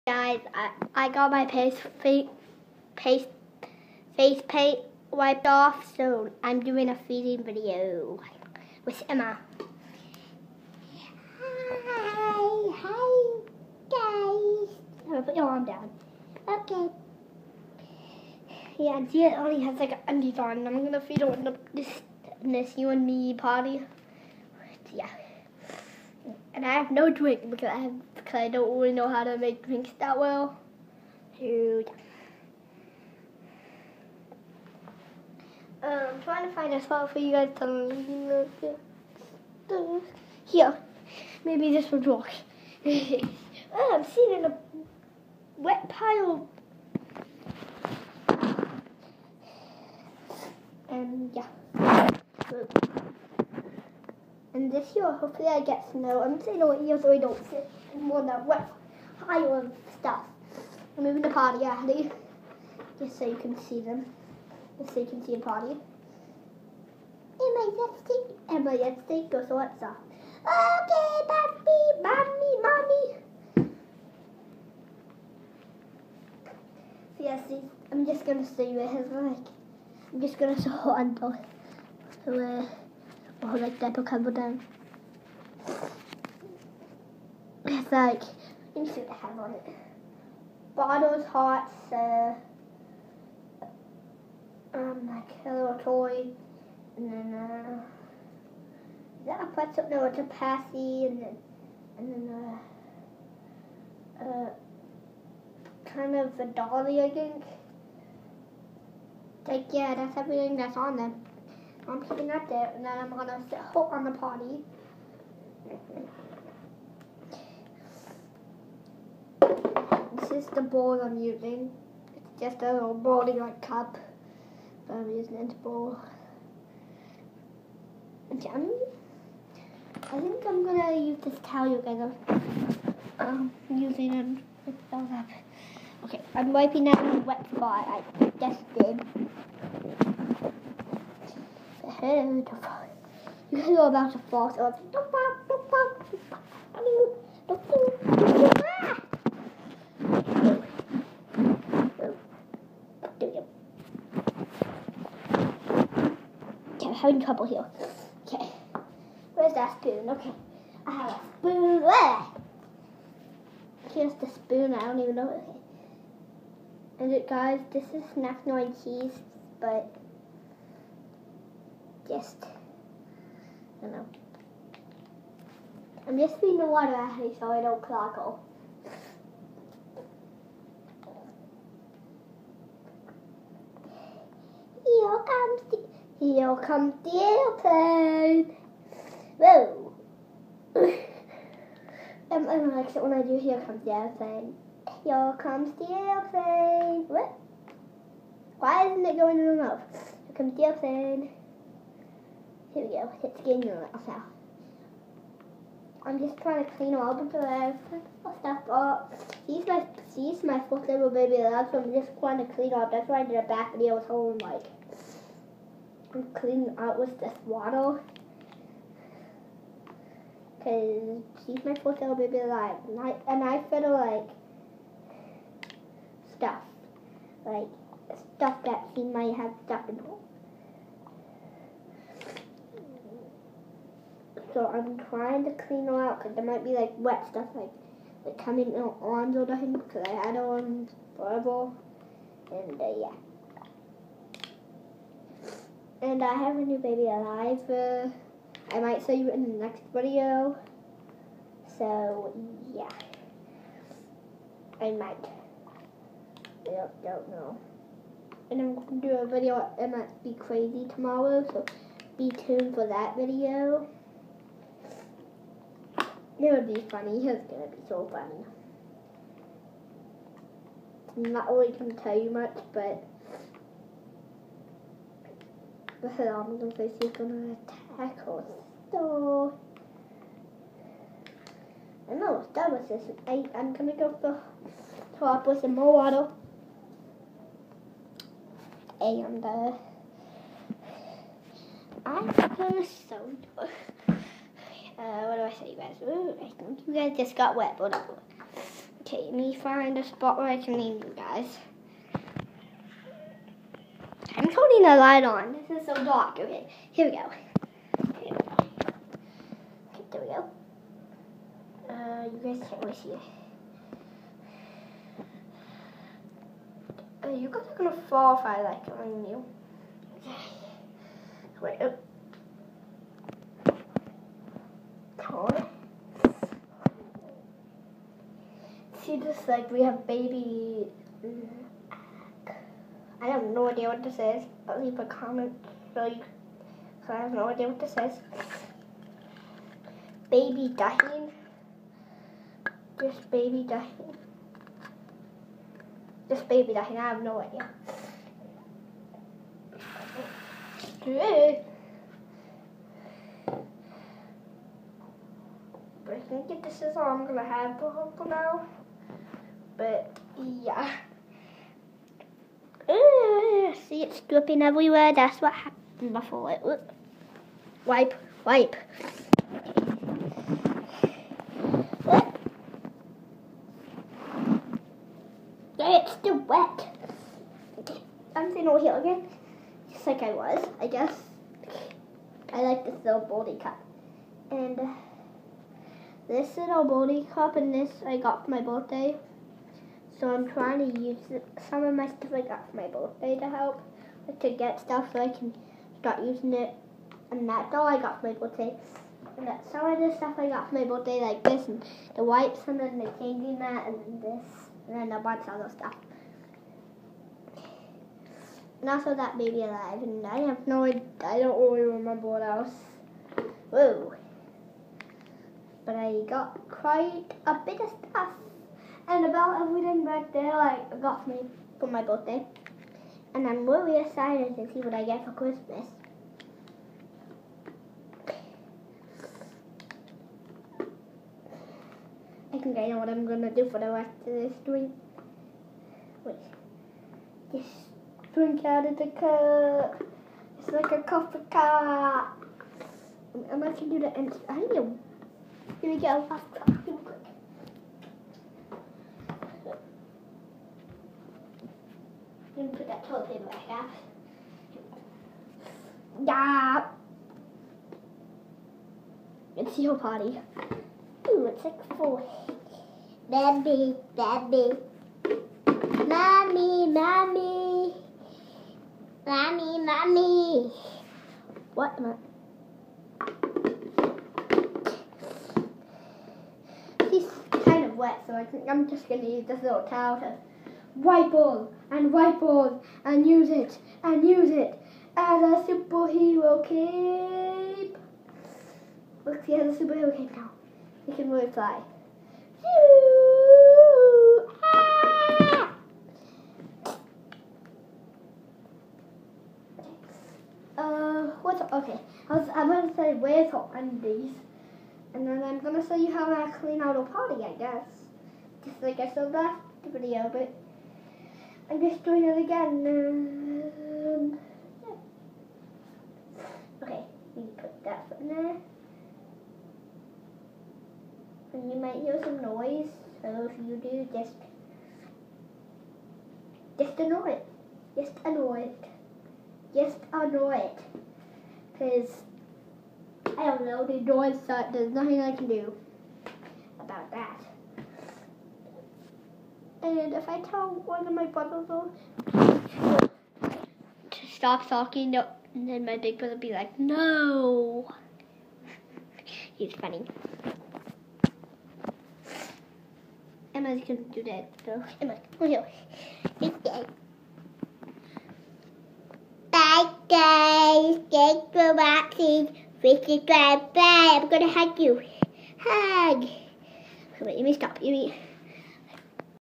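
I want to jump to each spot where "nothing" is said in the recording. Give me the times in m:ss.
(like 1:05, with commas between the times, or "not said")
3:59, 8:54.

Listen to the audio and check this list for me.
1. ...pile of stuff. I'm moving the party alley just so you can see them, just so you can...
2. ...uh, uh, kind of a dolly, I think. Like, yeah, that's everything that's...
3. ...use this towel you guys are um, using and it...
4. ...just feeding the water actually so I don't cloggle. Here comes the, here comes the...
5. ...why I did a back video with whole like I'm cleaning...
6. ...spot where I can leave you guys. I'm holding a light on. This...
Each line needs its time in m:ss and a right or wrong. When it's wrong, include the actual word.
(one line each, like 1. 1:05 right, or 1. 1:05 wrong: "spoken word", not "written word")
1. 0:59 right
2. 1:44 right
3. 2:10 right
4. 2:56 right
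5. 3:33 right
6. 5:00 right.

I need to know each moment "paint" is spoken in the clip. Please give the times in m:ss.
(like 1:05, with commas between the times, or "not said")
0:04.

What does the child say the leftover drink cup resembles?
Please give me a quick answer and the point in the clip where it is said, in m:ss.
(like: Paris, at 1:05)
a coffee cup, at 7:21.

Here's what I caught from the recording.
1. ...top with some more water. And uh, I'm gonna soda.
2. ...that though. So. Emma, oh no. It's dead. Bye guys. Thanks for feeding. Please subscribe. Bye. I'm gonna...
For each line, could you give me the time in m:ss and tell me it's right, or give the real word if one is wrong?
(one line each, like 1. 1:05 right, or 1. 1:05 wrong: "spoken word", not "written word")
1. 4:45 right
2. 9:14 wrong: "watching", not "feeding".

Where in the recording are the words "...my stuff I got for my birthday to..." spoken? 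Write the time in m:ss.
6:31.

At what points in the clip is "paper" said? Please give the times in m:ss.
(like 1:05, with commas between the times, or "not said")
7:33.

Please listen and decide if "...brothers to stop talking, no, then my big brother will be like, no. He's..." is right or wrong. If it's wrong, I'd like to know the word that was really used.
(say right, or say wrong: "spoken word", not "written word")
right.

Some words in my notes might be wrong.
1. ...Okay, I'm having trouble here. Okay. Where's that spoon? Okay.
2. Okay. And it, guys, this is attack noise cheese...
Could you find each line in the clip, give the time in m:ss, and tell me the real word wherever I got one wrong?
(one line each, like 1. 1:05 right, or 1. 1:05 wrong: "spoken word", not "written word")
1. 2:33 right
2. 2:45 wrong: "snack", not "attack".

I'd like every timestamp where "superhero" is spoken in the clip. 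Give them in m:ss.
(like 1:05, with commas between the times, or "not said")
8:05, 8:09.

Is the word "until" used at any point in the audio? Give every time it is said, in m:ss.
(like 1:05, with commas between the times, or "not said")
1:20.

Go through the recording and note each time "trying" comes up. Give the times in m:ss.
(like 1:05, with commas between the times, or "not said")
0:36, 3:26, 3:32, 3:55, 6:30.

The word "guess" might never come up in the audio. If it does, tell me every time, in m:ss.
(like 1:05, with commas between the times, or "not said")
6:20, 8:27.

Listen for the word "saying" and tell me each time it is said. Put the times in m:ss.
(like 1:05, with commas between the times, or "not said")
0:56.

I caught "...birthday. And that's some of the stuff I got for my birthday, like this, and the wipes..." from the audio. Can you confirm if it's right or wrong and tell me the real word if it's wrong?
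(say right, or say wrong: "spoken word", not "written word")
right.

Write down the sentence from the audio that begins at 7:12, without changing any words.
I think I know what I'm gonna do for the rest of this drink.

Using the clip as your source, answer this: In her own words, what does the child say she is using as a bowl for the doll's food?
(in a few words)
a little bowling like cup.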